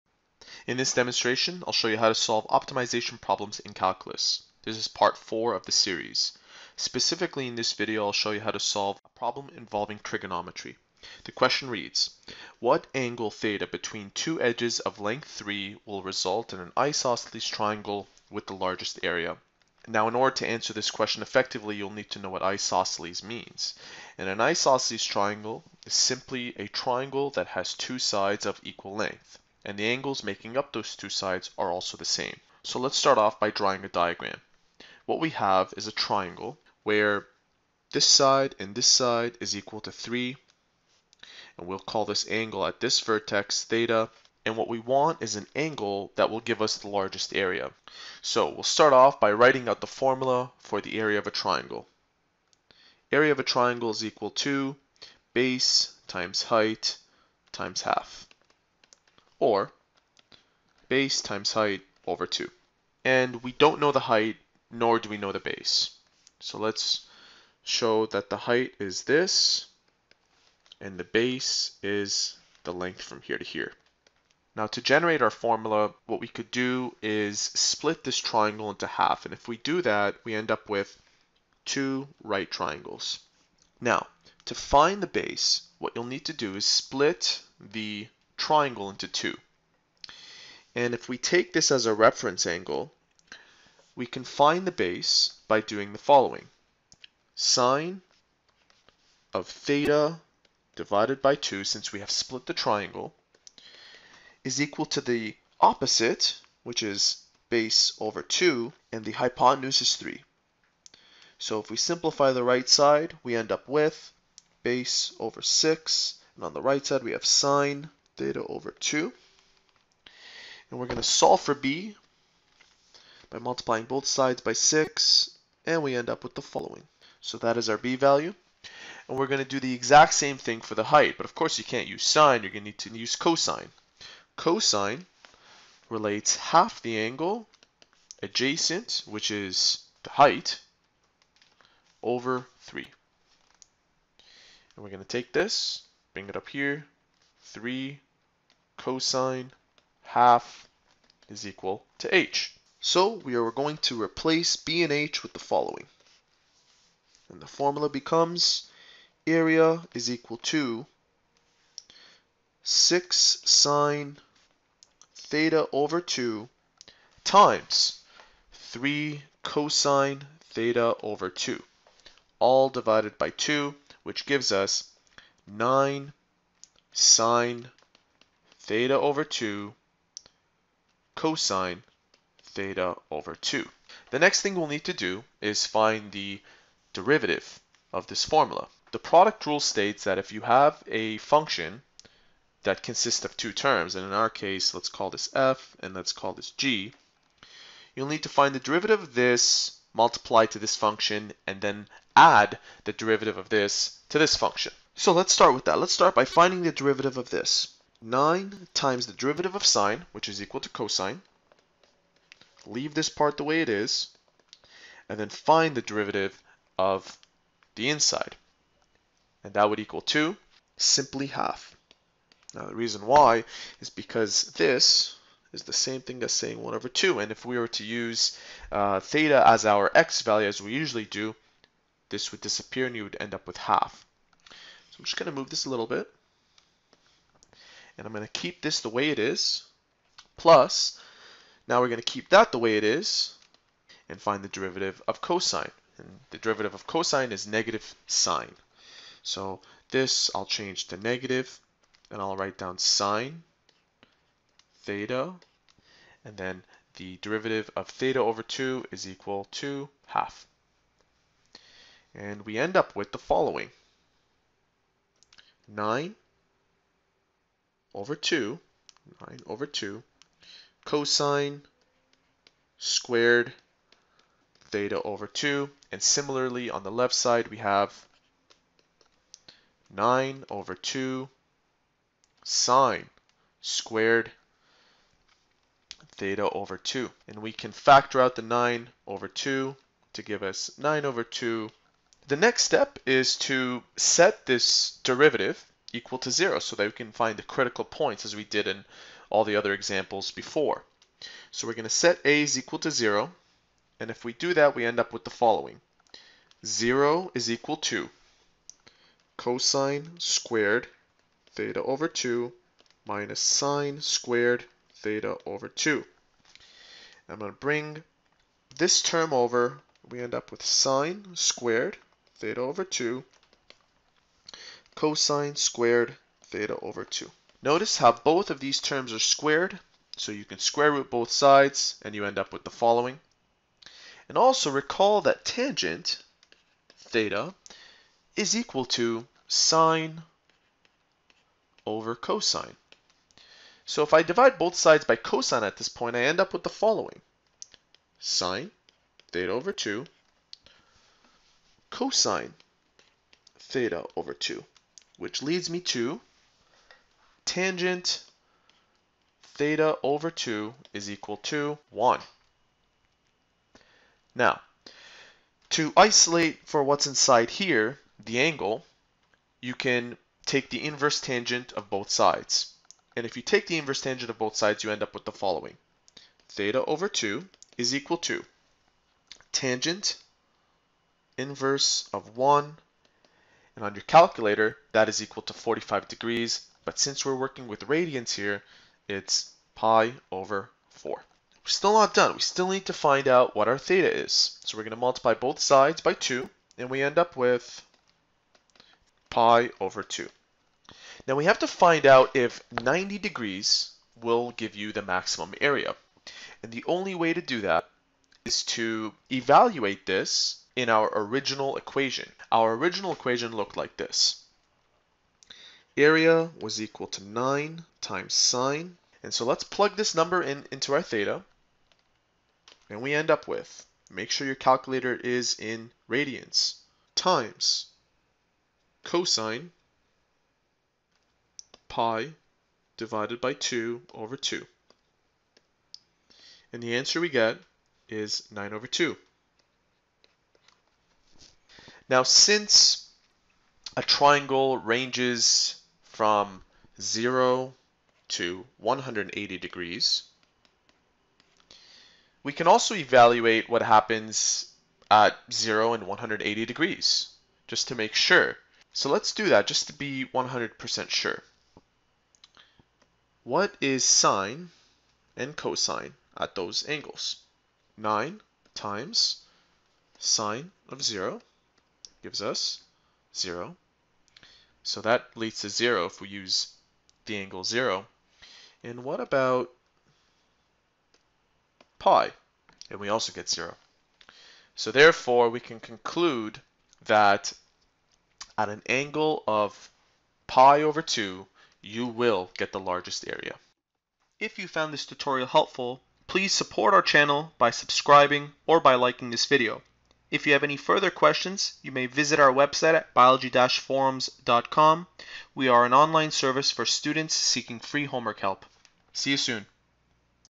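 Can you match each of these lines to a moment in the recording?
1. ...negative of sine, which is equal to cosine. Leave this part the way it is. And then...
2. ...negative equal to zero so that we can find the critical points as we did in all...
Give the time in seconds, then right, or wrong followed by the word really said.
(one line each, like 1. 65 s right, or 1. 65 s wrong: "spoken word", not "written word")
1. 209 s wrong: "derivative", not "negative"
2. 295 s wrong: "derivative", not "negative".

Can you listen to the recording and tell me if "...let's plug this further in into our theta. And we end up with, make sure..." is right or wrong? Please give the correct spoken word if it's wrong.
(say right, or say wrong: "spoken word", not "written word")
wrong: "number", not "further".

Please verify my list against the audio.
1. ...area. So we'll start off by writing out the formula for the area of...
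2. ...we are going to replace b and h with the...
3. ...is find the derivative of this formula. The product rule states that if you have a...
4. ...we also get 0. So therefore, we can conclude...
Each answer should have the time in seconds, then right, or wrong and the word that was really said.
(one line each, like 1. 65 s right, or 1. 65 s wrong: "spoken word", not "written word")
1. 47 s right
2. 153 s right
3. 185 s right
4. 482 s right.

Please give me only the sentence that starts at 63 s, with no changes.
And we don't know the height, nor do we know the base.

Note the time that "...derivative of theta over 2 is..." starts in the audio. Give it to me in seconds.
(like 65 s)
257 s.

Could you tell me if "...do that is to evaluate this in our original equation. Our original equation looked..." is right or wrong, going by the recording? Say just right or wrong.
right.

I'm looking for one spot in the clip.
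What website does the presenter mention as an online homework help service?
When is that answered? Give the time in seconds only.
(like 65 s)
503 s.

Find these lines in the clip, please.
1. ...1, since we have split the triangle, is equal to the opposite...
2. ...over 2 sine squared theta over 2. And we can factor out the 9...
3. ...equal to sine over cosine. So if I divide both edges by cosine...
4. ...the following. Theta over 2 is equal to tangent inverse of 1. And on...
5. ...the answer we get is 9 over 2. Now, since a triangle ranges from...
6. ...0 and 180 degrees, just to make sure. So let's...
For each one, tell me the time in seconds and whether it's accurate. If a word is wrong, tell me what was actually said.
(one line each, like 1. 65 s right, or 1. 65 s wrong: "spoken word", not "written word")
1. 101 s wrong: "2", not "1"
2. 280 s right
3. 338 s wrong: "sides", not "edges"
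4. 375 s right
5. 436 s right
6. 455 s right.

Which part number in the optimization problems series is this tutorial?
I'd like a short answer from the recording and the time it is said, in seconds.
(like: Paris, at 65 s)
4, at 4 s.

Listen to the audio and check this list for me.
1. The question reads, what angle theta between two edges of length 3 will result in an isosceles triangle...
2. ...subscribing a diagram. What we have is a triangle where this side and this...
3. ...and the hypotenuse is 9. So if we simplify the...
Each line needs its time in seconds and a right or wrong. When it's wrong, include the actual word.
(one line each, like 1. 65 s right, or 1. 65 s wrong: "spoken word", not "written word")
1. 11 s right
2. 33 s wrong: "drawing", not "subscribing"
3. 108 s wrong: "3", not "9".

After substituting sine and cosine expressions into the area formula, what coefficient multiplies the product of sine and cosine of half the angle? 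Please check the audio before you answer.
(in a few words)
9.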